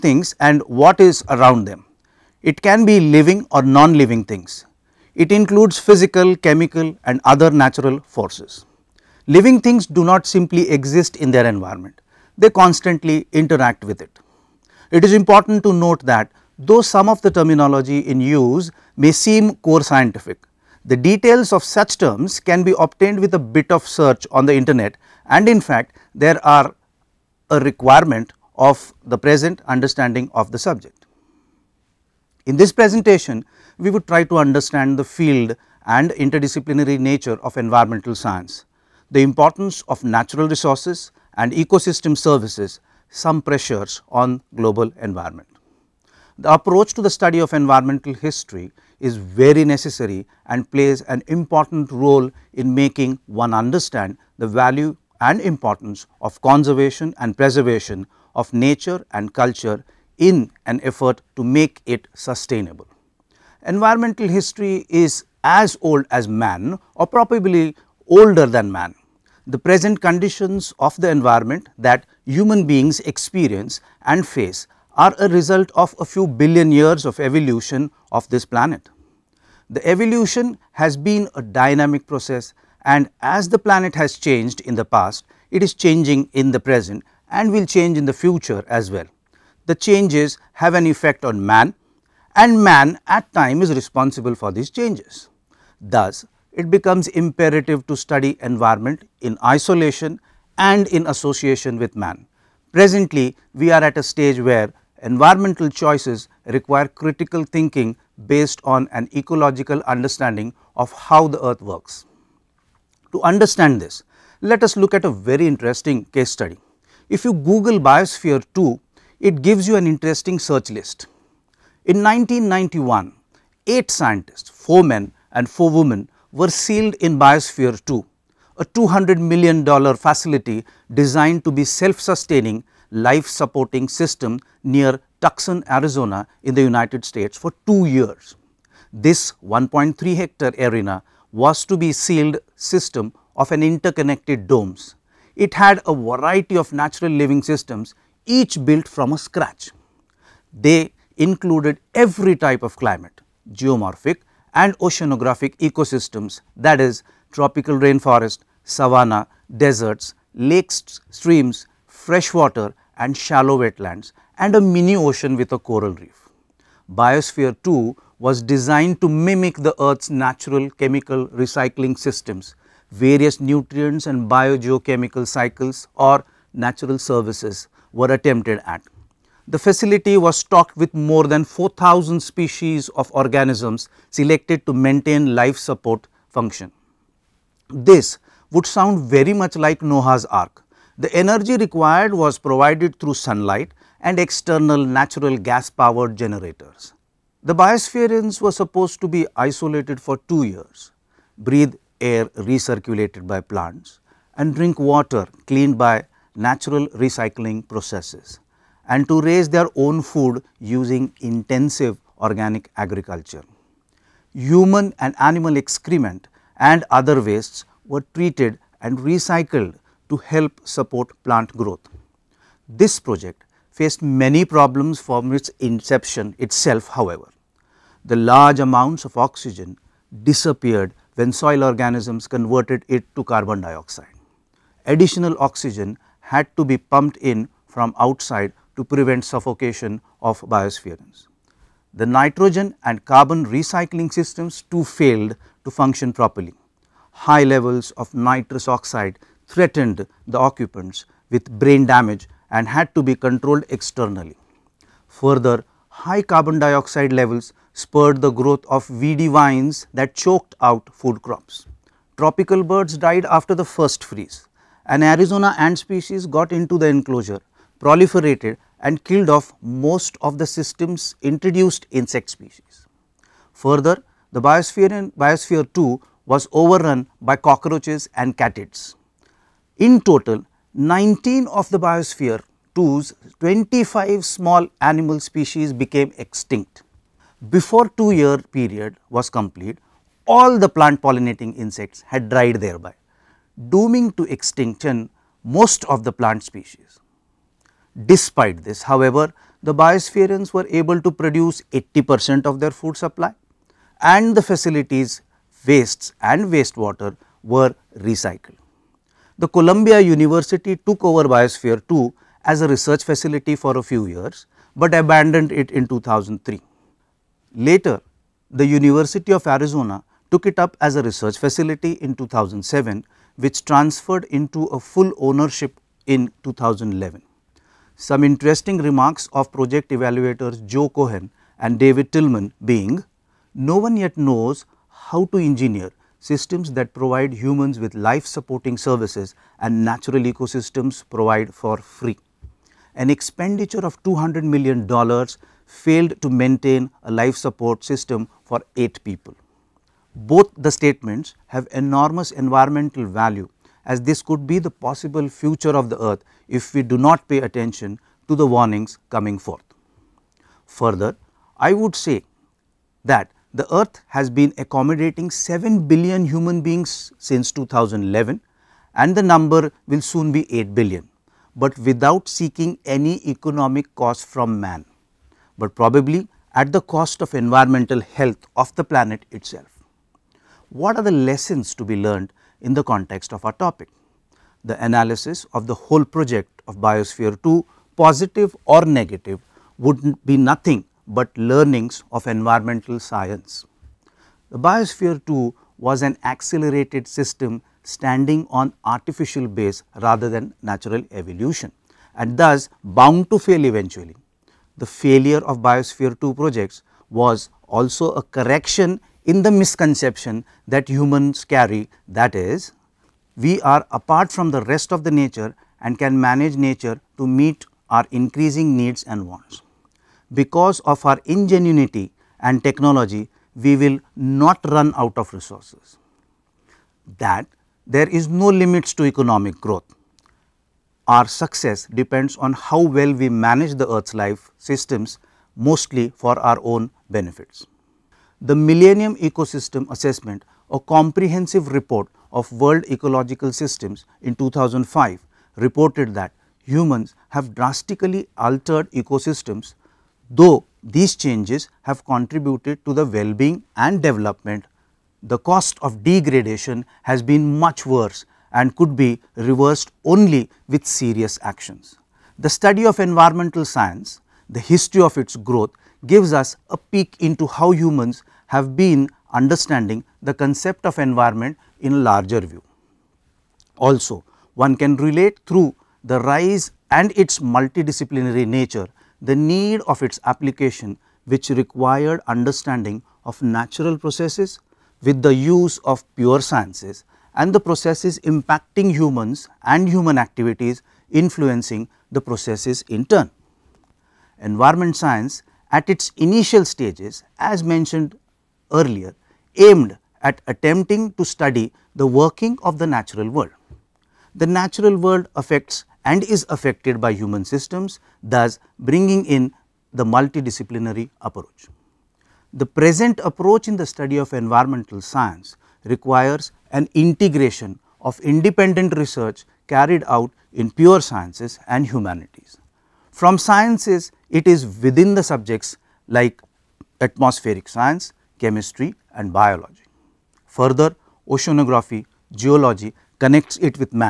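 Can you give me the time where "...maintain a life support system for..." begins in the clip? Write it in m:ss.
5:46.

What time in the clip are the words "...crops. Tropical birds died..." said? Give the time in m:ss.
4:21.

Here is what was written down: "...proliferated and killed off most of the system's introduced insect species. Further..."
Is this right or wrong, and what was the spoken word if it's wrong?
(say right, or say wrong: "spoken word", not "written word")
right.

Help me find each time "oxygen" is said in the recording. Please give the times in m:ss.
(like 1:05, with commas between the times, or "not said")
3:49, 3:55.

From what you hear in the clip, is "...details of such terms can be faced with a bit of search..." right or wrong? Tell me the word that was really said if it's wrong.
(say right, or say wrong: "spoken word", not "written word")
wrong: "obtained", not "faced".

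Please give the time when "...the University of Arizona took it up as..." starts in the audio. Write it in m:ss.
5:18.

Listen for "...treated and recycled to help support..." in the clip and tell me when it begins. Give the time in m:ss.
3:38.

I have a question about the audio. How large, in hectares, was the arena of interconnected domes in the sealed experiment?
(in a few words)
1.3 hectares.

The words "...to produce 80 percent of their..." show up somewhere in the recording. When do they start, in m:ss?
5:01.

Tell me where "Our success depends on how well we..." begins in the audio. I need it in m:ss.
7:11.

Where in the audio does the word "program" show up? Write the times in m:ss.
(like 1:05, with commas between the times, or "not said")
not said.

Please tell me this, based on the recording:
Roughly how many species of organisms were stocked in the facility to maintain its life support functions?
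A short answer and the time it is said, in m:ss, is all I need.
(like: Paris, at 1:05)
4000, at 3:01.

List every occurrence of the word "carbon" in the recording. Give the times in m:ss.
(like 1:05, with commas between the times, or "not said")
3:53, 4:03, 4:16.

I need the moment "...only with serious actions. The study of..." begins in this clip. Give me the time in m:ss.
7:40.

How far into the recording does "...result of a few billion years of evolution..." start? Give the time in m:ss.
1:15.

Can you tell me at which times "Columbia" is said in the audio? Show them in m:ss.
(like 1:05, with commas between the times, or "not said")
5:09.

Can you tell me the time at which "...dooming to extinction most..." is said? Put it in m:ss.
4:53.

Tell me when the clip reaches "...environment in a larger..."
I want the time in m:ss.
7:50.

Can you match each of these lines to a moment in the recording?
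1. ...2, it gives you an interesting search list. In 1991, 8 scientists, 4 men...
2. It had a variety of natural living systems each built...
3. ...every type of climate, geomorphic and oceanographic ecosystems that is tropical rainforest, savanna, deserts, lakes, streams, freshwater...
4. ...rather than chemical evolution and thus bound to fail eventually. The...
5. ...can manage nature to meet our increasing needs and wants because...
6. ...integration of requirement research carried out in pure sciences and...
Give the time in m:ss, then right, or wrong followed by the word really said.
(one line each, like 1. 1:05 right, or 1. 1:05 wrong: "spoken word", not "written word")
1. 1:58 right
2. 2:25 right
3. 2:31 right
4. 6:40 wrong: "natural", not "chemical"
5. 6:55 right
6. 8:36 wrong: "independent", not "requirement".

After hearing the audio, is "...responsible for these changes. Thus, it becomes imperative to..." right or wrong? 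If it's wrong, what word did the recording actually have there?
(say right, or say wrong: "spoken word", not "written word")
right.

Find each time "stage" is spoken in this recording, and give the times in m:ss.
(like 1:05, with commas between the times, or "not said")
1:44, 8:16.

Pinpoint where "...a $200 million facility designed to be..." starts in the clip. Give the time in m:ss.
2:08.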